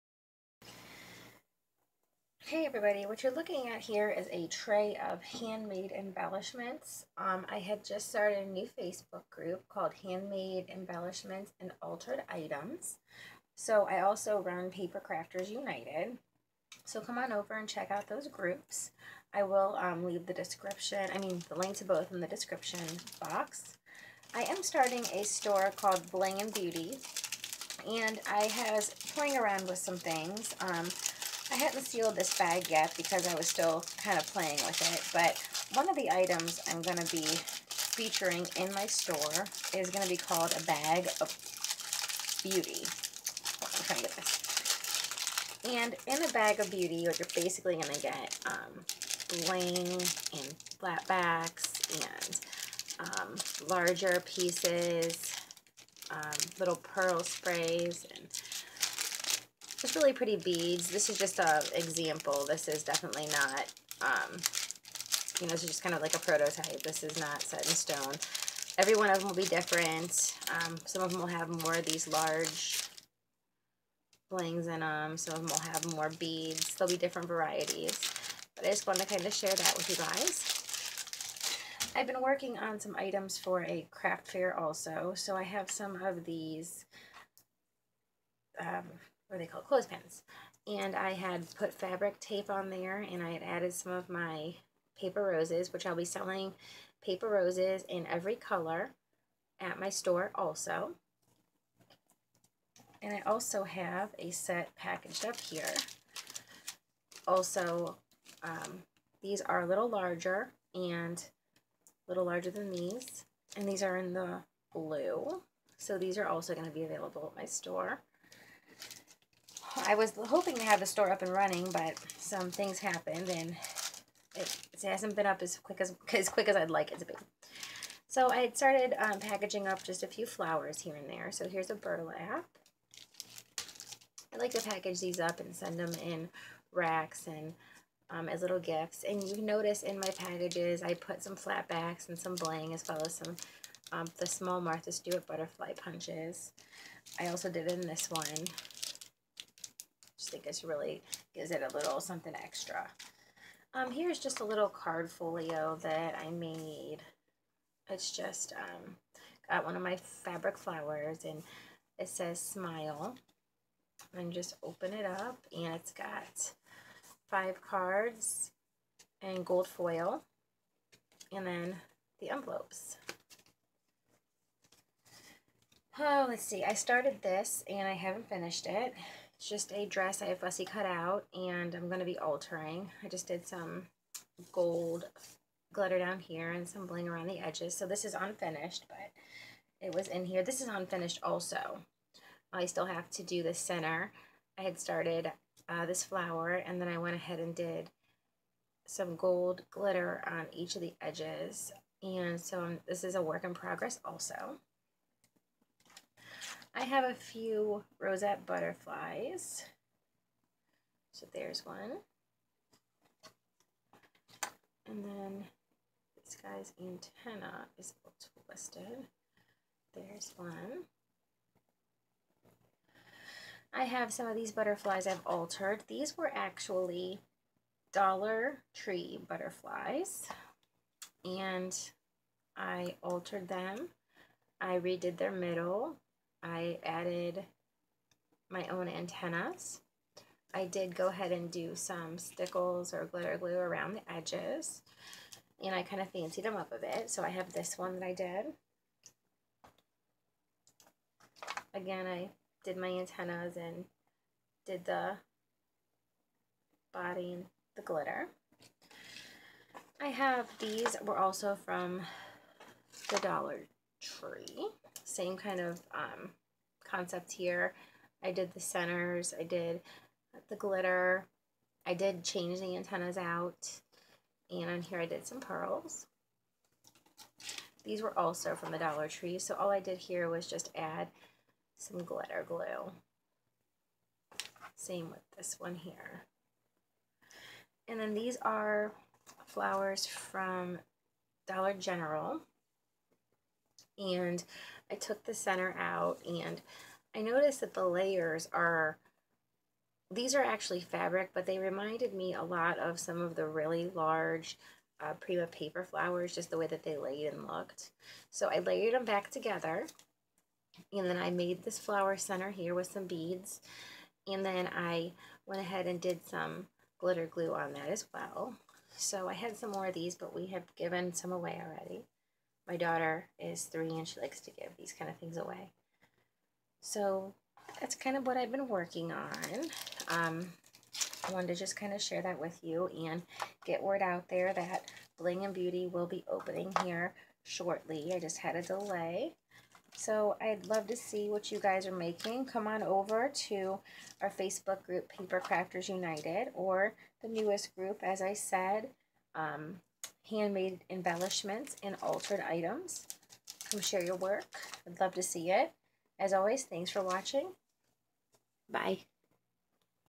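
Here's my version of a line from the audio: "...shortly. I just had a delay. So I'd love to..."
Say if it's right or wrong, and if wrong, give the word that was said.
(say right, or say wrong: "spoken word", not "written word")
right.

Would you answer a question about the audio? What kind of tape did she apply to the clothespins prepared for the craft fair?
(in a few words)
fabric tape.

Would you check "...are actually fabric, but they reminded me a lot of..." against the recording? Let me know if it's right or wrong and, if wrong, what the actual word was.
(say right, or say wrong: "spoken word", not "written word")
right.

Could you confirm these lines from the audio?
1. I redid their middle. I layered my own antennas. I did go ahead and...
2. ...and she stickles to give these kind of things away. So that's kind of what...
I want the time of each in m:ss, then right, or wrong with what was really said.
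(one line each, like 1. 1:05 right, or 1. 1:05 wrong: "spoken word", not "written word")
1. 3:54 wrong: "added", not "layered"
2. 5:23 wrong: "likes", not "stickles".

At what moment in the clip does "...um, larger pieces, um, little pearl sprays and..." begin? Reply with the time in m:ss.
0:53.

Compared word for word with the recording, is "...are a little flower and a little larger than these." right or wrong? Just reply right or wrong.
wrong.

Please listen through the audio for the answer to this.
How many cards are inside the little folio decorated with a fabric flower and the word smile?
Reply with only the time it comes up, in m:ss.
2:47.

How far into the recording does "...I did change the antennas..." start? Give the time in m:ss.
4:31.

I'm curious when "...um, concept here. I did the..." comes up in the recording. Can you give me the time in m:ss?
4:25.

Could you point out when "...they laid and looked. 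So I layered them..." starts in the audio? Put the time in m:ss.
5:06.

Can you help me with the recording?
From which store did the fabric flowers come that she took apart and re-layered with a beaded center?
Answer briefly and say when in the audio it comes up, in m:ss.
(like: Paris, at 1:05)
Dollar General, at 4:51.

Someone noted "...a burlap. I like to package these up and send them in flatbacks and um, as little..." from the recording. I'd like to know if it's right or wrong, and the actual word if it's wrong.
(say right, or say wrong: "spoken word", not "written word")
wrong: "racks", not "flatbacks".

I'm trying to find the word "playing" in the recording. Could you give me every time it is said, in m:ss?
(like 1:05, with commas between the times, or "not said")
0:29, 0:34.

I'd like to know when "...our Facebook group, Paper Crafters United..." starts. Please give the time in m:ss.
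5:44.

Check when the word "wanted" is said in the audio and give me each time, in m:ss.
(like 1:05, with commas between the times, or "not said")
1:18, 5:31.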